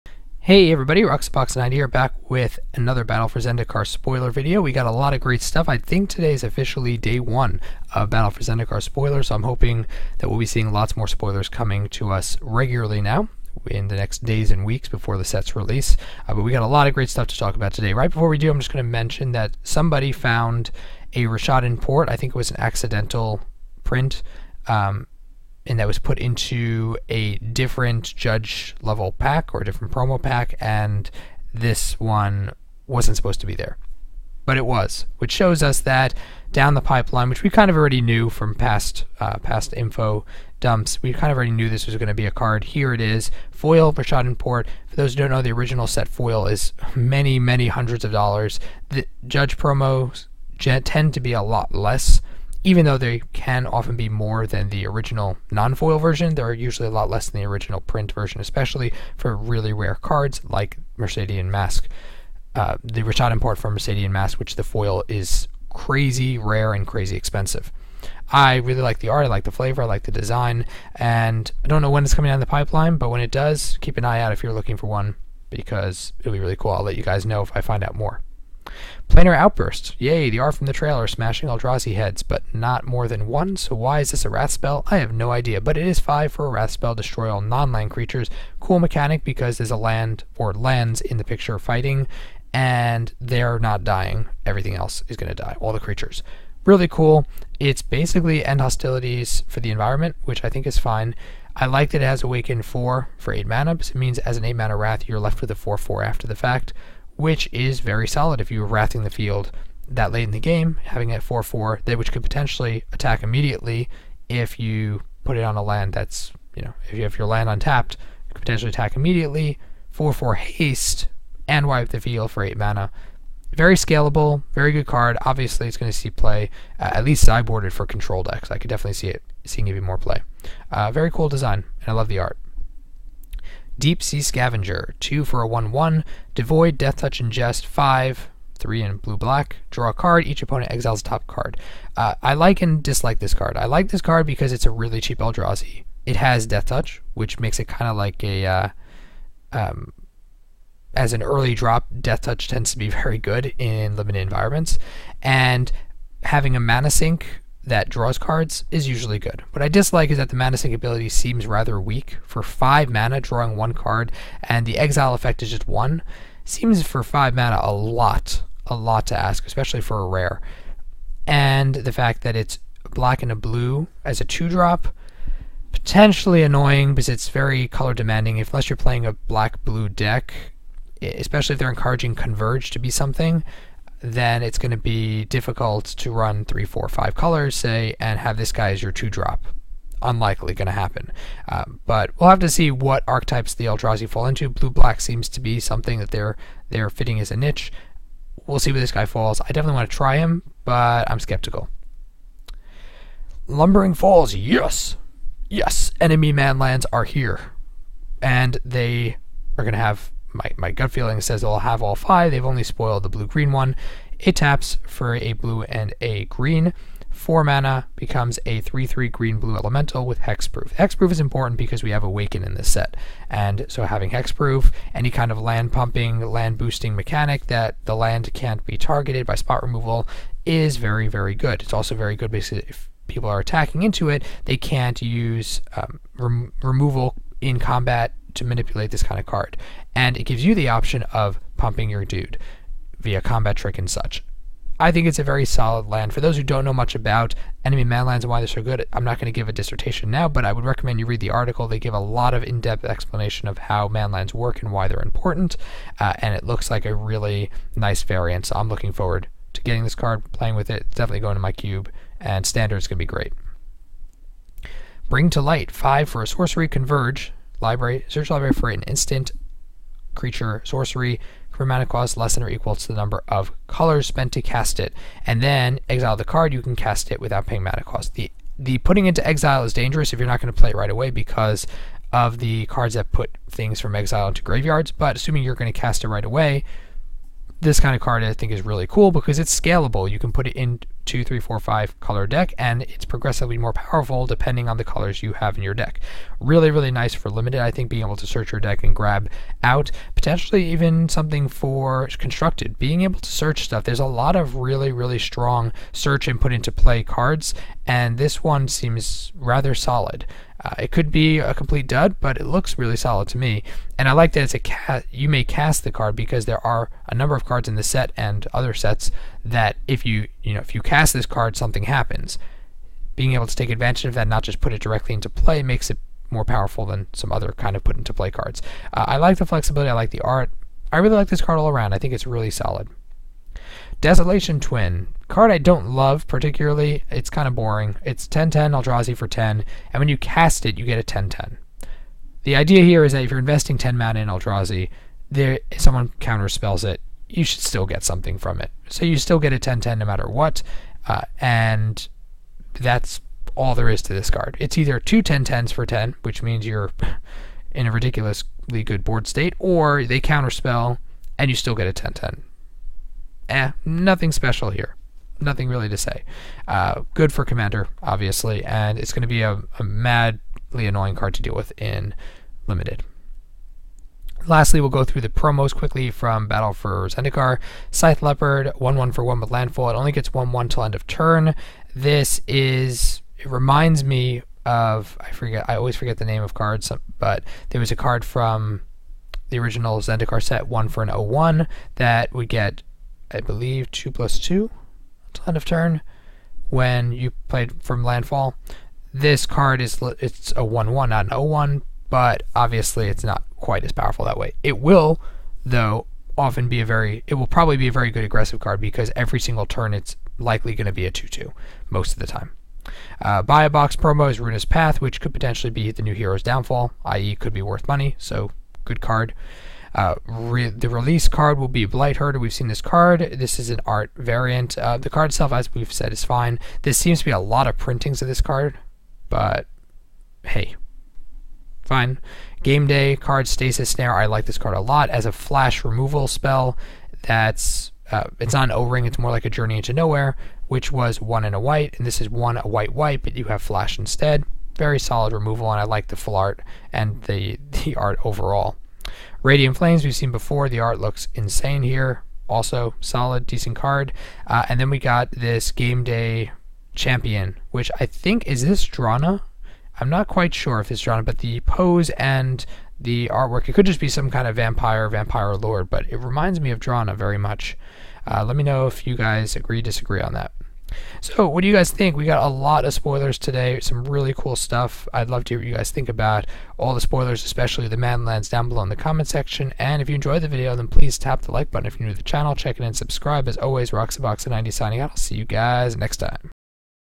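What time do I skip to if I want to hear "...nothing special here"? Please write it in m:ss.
6:03.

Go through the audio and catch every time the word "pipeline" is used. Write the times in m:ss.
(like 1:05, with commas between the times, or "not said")
0:36, 1:12.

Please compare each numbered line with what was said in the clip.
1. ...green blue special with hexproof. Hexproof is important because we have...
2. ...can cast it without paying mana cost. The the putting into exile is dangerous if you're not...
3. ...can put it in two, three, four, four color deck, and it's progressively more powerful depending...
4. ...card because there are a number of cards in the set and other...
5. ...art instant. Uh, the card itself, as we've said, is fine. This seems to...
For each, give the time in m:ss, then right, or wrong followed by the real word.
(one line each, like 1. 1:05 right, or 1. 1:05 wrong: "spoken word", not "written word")
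1. 3:39 wrong: "elemental", not "special"
2. 4:36 right
3. 4:50 wrong: "five", not "four"
4. 5:15 right
5. 7:03 wrong: "variant", not "instant".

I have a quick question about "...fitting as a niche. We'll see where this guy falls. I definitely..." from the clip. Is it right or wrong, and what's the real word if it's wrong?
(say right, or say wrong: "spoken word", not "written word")
right.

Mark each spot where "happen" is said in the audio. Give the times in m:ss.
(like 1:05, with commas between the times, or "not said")
3:10, 5:21.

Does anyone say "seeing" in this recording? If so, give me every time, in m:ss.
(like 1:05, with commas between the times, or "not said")
0:10, 2:09.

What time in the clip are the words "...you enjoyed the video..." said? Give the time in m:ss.
8:00.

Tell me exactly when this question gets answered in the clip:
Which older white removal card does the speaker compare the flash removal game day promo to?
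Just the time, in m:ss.
7:19.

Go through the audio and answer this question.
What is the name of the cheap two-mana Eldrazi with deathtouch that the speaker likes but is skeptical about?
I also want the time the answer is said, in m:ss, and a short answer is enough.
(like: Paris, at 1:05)
Deep Sea Scavenger, at 2:13.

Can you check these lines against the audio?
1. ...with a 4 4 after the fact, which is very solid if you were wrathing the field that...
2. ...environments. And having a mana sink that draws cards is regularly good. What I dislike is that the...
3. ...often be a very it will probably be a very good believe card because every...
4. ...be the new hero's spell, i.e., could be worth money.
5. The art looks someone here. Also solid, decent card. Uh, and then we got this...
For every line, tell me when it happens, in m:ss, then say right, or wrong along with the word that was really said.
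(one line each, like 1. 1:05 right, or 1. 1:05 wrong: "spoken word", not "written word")
1. 1:45 right
2. 2:34 wrong: "usually", not "regularly"
3. 6:46 wrong: "aggressive", not "believe"
4. 6:55 wrong: "downfall", not "spell"
5. 7:30 wrong: "insane", not "someone".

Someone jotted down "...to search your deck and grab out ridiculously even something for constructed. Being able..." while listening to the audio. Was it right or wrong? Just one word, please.
wrong.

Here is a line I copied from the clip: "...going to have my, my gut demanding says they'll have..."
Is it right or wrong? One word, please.
wrong.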